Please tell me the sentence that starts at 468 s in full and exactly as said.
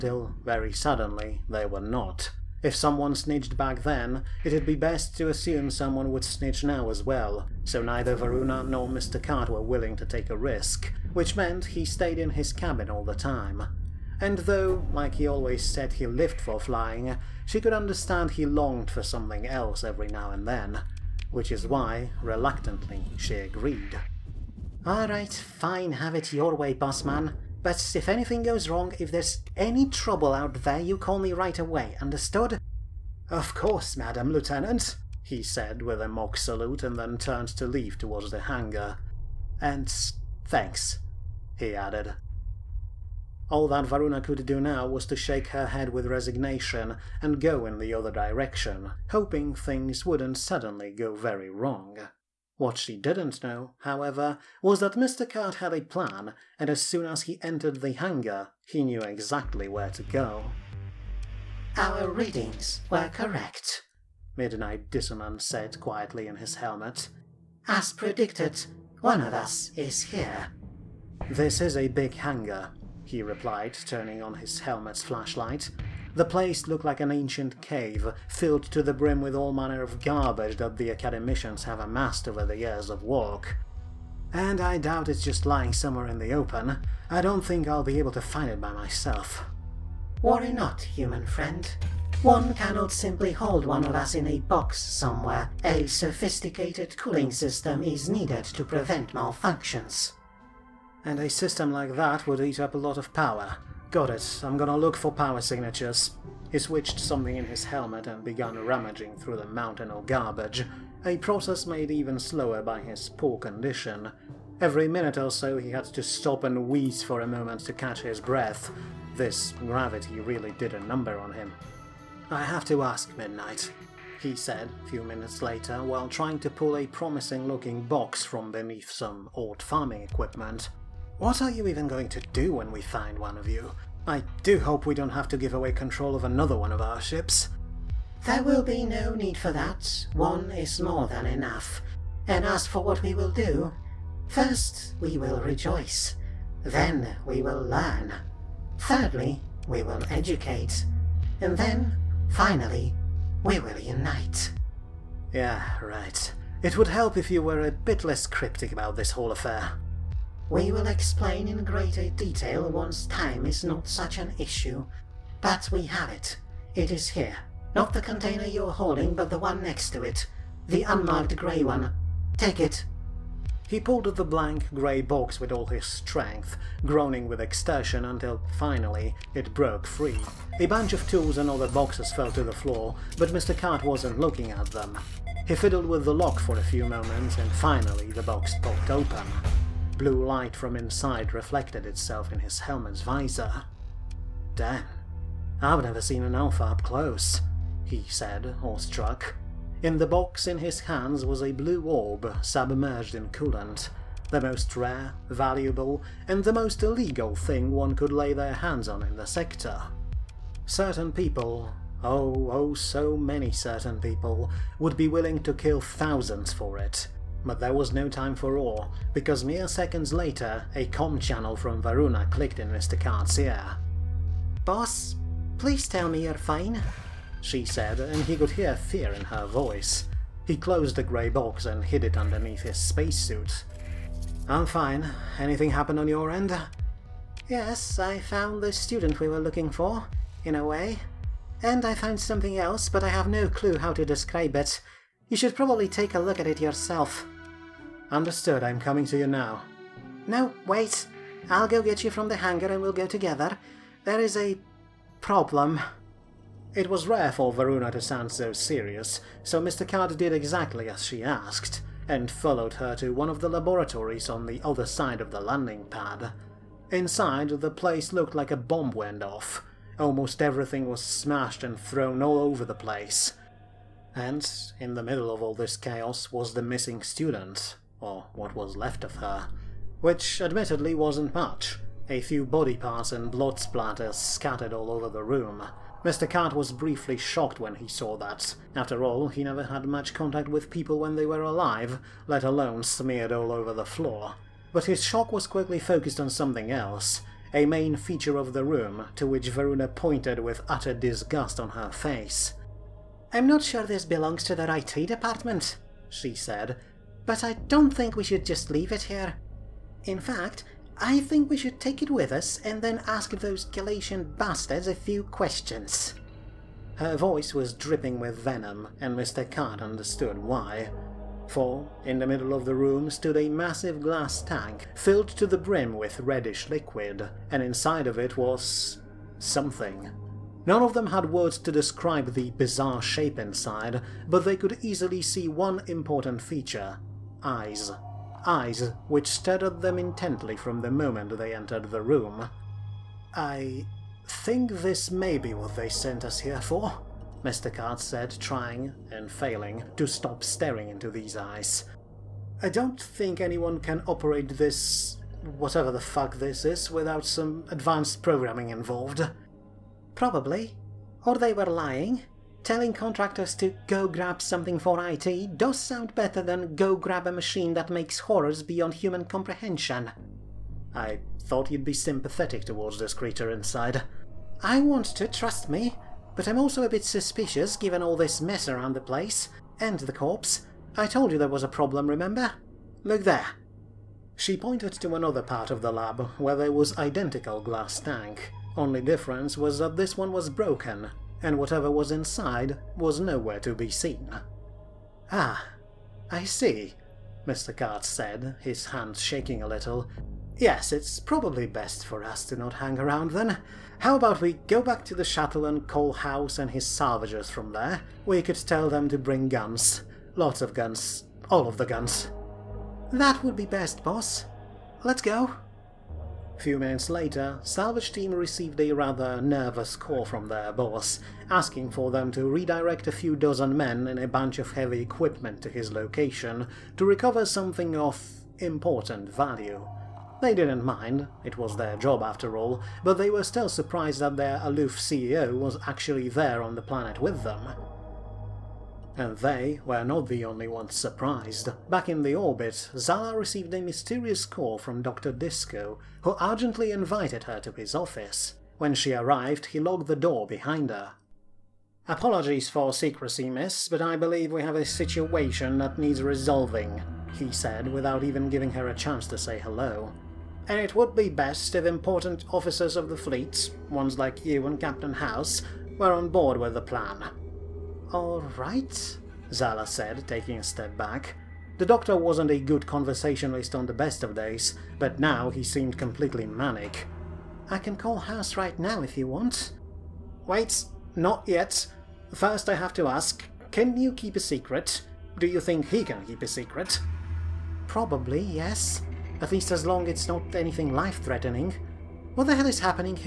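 Alright, Zala said, taking a step back.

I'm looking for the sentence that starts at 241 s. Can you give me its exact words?
And I found something else, but I have no clue how to describe it.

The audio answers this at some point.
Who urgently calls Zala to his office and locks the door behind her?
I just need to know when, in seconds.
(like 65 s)
445 s.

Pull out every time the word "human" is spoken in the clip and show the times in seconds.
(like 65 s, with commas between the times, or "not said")
90 s, 368 s.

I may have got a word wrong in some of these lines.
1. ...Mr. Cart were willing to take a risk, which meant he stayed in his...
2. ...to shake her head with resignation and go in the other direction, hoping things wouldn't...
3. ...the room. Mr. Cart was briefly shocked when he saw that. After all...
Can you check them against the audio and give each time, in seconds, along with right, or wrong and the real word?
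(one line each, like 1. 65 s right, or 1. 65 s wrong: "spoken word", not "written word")
1. 8 s right
2. 45 s right
3. 285 s right.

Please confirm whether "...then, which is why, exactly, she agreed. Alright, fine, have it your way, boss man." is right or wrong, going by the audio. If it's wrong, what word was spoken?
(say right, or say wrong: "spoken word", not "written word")
wrong: "reluctantly", not "exactly".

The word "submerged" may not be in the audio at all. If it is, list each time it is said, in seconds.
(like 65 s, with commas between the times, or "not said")
202 s.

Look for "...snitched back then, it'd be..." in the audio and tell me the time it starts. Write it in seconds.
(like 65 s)
3 s.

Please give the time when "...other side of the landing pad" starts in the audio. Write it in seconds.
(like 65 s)
264 s.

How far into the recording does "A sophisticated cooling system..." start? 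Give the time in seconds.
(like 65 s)
95 s.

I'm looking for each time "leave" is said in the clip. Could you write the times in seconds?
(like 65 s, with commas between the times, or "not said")
37 s, 308 s.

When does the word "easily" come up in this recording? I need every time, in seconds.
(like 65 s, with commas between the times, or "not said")
334 s.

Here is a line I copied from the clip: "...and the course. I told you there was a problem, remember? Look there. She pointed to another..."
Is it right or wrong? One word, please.
wrong.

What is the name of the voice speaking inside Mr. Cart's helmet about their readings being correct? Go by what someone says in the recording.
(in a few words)
Midnight Dissonance.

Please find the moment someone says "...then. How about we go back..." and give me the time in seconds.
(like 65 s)
403 s.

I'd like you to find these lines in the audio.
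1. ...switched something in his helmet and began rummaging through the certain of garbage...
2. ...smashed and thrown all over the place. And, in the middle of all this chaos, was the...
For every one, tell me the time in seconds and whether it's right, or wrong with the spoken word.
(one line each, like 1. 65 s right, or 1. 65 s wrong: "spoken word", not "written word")
1. 106 s wrong: "mountain", not "certain"
2. 271 s right.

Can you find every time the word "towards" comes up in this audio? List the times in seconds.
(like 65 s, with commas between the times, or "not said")
37 s, 372 s.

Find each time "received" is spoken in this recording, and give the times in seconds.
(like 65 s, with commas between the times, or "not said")
418 s, 443 s.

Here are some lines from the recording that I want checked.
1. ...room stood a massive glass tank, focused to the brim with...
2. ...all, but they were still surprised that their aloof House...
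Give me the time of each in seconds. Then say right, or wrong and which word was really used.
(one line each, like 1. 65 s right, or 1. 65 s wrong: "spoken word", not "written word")
1. 322 s wrong: "filled", not "focused"
2. 432 s wrong: "CEO", not "House".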